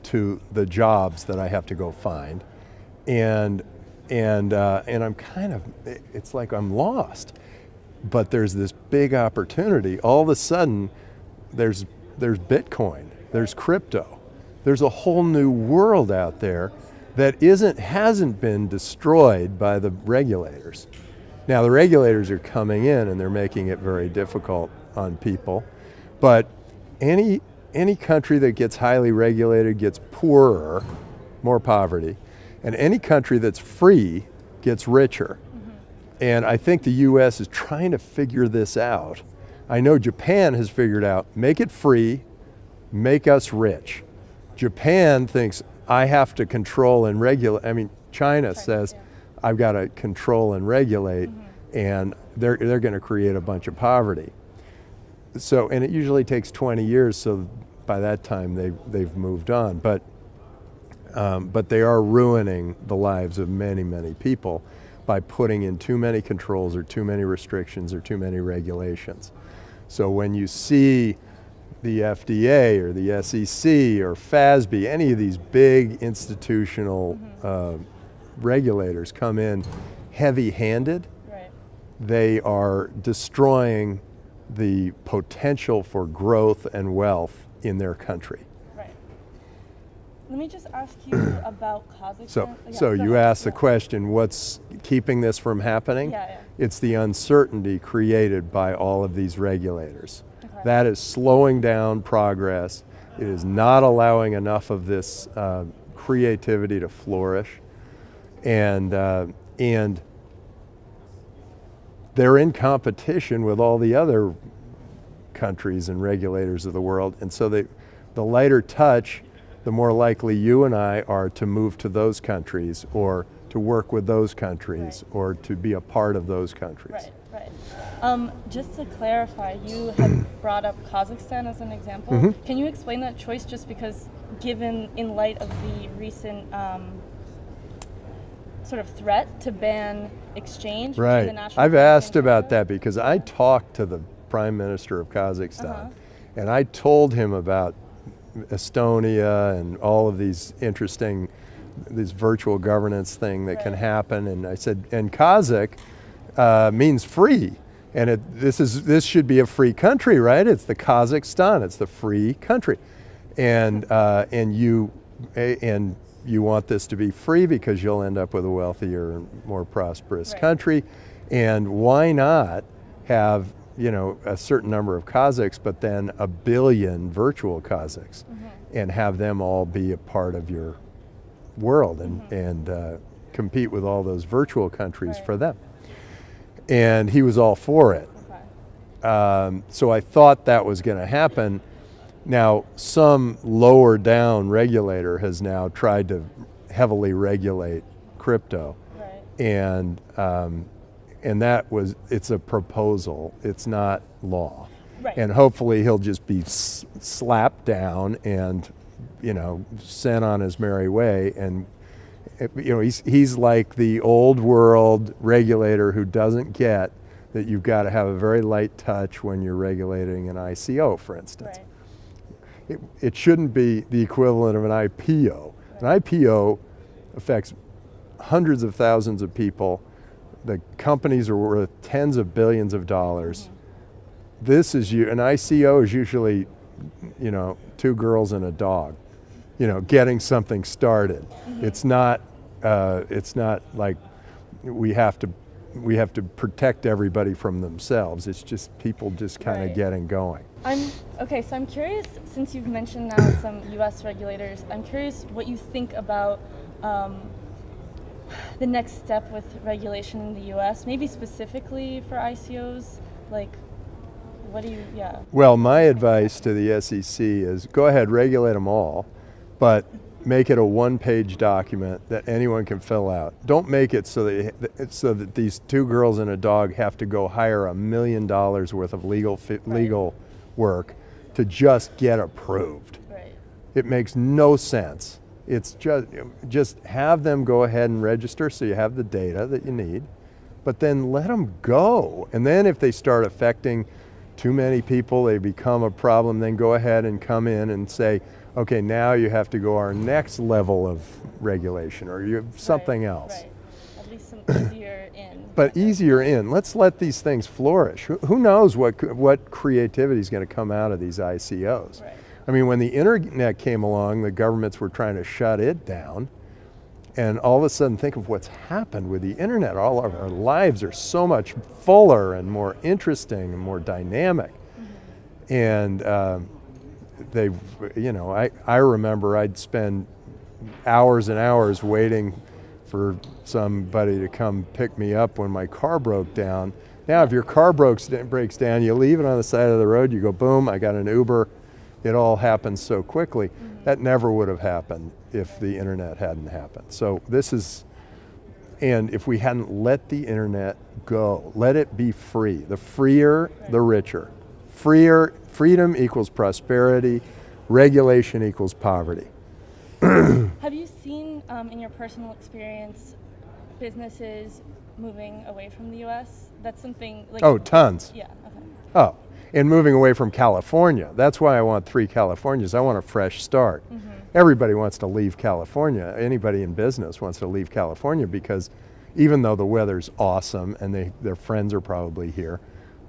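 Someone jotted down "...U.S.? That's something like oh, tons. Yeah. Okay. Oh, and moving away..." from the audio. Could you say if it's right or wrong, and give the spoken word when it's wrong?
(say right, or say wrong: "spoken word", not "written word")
right.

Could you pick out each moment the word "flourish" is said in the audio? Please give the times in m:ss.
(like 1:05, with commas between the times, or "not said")
1:46, 5:07.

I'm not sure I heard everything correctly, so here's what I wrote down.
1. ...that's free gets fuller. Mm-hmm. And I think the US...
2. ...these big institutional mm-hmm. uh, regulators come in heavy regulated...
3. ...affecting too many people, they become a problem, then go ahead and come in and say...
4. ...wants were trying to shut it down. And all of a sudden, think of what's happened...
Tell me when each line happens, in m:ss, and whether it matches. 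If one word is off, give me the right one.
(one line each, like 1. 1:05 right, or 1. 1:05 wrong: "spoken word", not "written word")
1. 0:33 wrong: "richer", not "fuller"
2. 1:15 wrong: "handed", not "regulated"
3. 4:53 right
4. 5:14 wrong: "governments", not "wants".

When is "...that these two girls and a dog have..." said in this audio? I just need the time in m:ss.
4:35.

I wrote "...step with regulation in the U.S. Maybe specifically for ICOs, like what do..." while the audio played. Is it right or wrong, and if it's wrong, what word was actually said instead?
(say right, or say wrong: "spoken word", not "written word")
right.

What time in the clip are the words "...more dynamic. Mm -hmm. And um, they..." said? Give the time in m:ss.
5:23.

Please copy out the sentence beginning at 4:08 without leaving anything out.
It's just people just kind of right.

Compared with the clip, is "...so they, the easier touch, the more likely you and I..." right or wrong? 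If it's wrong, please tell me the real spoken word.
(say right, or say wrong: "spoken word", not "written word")
wrong: "lighter", not "easier".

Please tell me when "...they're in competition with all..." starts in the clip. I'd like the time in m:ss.
1:52.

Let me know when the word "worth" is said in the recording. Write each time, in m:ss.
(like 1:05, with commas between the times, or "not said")
3:51, 4:38.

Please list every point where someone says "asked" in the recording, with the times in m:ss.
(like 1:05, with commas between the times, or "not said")
1:33, 2:21.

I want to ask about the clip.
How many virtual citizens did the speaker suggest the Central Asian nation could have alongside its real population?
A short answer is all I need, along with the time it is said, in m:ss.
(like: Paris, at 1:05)
a billion, at 2:56.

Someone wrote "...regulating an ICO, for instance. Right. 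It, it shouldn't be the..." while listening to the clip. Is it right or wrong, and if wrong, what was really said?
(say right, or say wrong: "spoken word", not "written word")
right.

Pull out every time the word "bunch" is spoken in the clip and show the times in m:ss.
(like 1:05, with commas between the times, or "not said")
0:53.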